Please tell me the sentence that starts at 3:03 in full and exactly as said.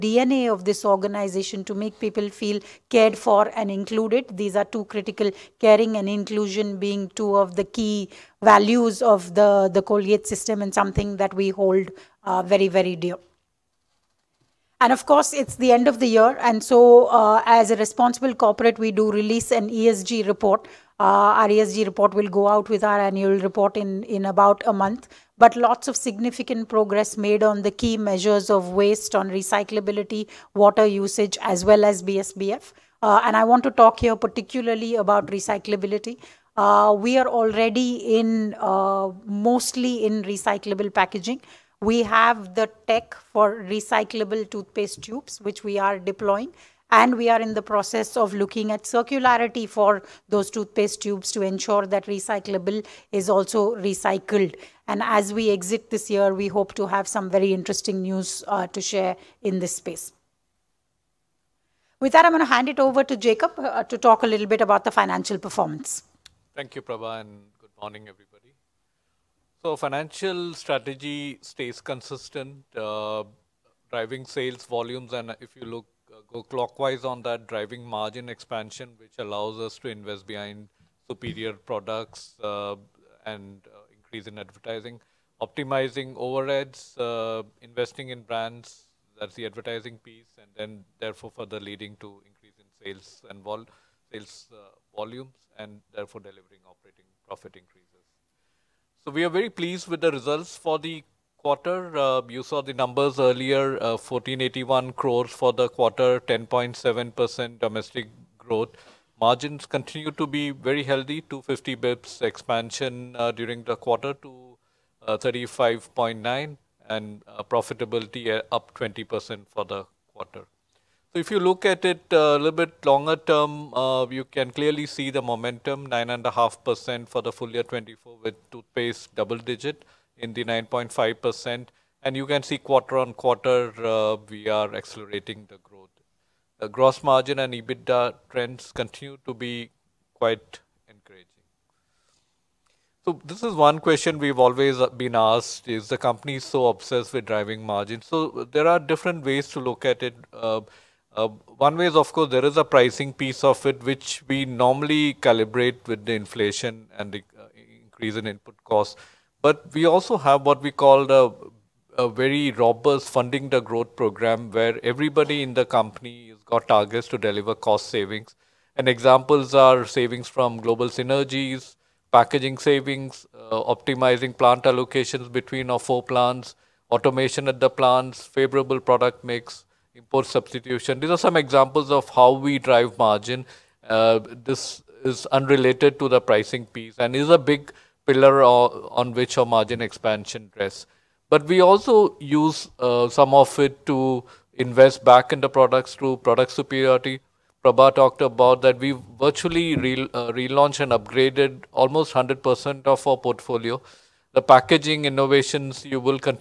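Uh, this is unrelated to the pricing piece and is a big pillar on which our margin expansion rests.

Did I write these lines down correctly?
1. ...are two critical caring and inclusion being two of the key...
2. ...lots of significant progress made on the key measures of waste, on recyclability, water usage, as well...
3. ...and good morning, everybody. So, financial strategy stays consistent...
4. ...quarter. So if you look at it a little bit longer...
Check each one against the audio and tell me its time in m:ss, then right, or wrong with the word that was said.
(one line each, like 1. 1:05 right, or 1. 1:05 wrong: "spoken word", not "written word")
1. 0:04 right
2. 0:25 right
3. 1:07 right
4. 2:00 right.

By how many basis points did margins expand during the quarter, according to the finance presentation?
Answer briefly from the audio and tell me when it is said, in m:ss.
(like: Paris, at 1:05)
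250, at 1:51.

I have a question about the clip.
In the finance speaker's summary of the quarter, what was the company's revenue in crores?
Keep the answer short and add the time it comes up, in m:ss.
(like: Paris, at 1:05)
1481 crores, at 1:43.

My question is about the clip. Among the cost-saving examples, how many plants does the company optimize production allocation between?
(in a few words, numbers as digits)
4.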